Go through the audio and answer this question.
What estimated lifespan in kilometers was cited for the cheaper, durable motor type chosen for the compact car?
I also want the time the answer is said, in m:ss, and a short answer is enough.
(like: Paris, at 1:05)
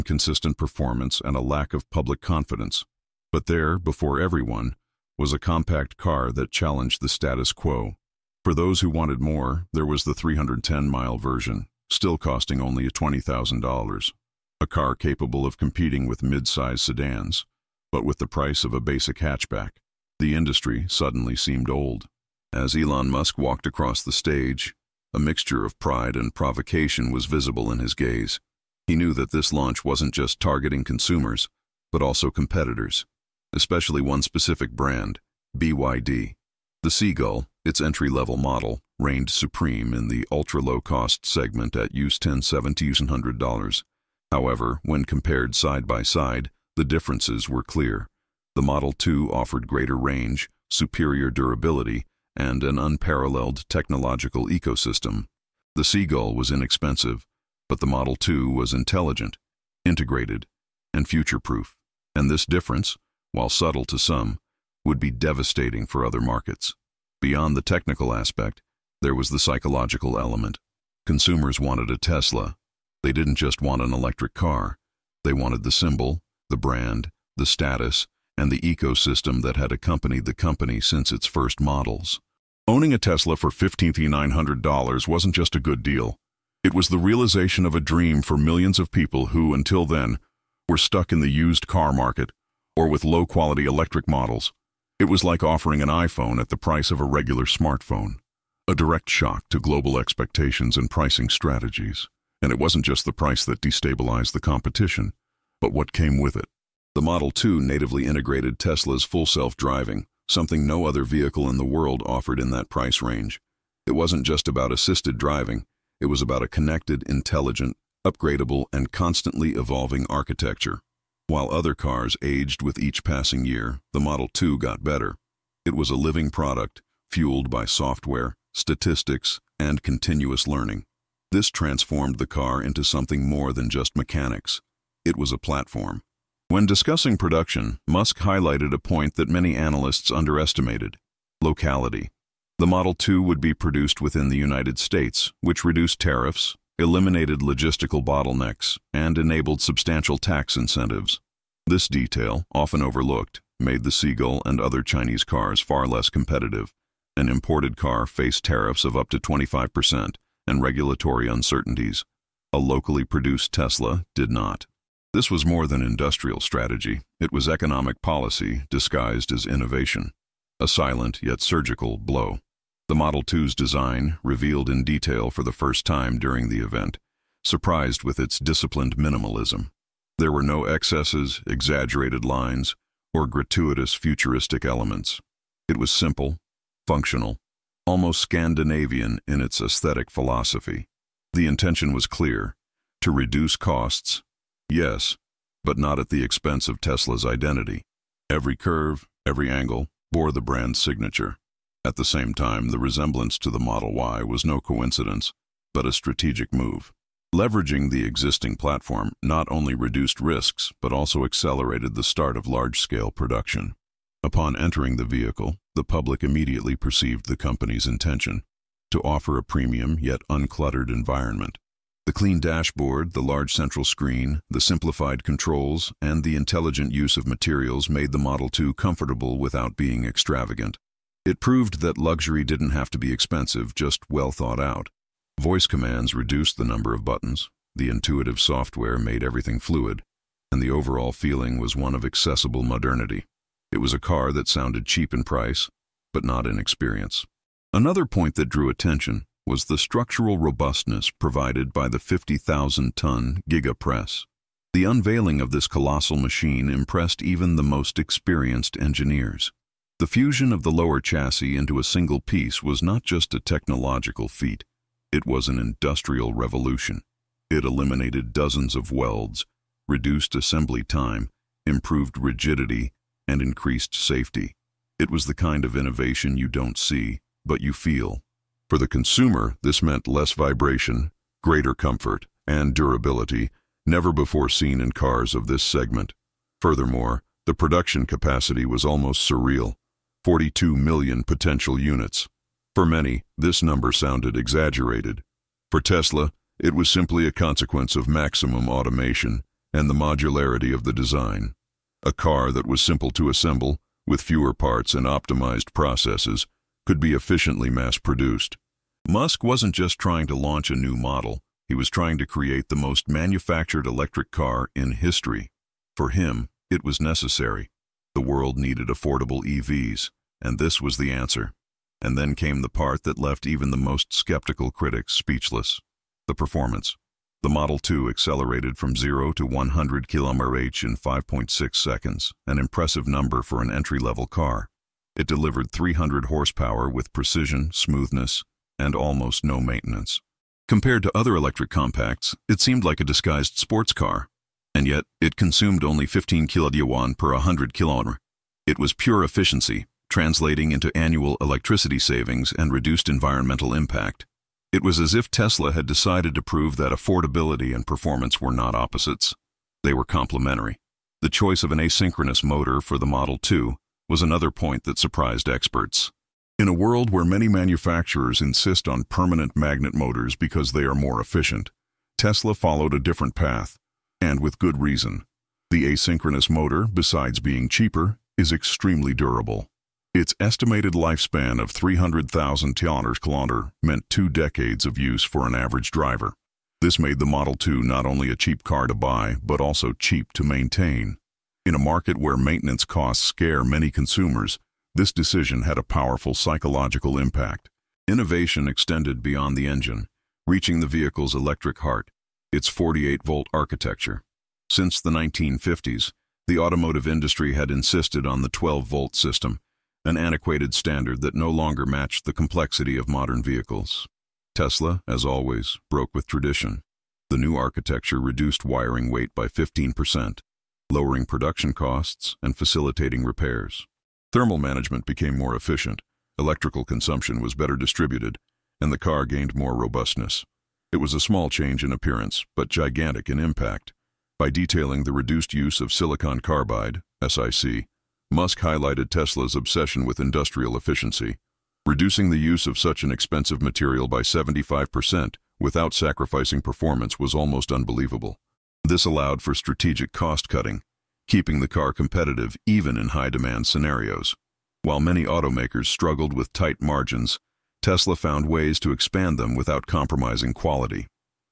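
300,000 km, at 6:21.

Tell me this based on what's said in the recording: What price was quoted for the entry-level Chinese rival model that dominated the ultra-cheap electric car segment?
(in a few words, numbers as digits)
$10,700.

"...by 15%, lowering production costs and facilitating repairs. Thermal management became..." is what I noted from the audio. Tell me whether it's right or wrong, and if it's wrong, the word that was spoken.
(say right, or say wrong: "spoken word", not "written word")
right.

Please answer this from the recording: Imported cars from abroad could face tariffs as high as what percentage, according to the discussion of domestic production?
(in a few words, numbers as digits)
25%.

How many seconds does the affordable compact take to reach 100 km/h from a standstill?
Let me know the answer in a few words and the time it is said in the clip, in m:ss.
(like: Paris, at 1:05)
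5.6 seconds, at 5:30.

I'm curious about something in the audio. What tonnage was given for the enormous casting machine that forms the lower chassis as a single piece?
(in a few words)
50,000 tons.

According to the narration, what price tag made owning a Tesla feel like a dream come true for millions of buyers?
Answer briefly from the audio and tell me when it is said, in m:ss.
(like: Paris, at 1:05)
$15,900, at 1:23.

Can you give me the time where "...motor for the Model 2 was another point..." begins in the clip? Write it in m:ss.
6:02.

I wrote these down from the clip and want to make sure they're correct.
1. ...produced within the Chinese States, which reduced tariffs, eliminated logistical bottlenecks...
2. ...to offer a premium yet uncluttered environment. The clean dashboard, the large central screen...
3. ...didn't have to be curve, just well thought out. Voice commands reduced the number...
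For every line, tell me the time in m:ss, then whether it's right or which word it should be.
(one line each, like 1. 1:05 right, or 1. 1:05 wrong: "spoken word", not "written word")
1. 2:23 wrong: "United", not "Chinese"
2. 3:38 right
3. 3:52 wrong: "expensive", not "curve".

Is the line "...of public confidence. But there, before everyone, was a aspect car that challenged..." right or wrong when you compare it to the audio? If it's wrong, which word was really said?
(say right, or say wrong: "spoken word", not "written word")
wrong: "compact", not "aspect".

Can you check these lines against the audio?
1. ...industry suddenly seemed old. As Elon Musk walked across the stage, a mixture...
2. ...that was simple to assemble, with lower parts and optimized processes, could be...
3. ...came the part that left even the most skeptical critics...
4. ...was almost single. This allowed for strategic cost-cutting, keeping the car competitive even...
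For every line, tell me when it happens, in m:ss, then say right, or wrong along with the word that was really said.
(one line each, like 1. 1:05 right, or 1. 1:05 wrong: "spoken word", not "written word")
1. 0:20 right
2. 5:02 wrong: "fewer", not "lower"
3. 5:22 right
4. 7:27 wrong: "unbelievable", not "single".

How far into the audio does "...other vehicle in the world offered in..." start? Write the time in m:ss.
1:50.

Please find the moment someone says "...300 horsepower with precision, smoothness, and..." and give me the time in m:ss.
5:35.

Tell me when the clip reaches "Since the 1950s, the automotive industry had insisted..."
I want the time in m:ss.
6:44.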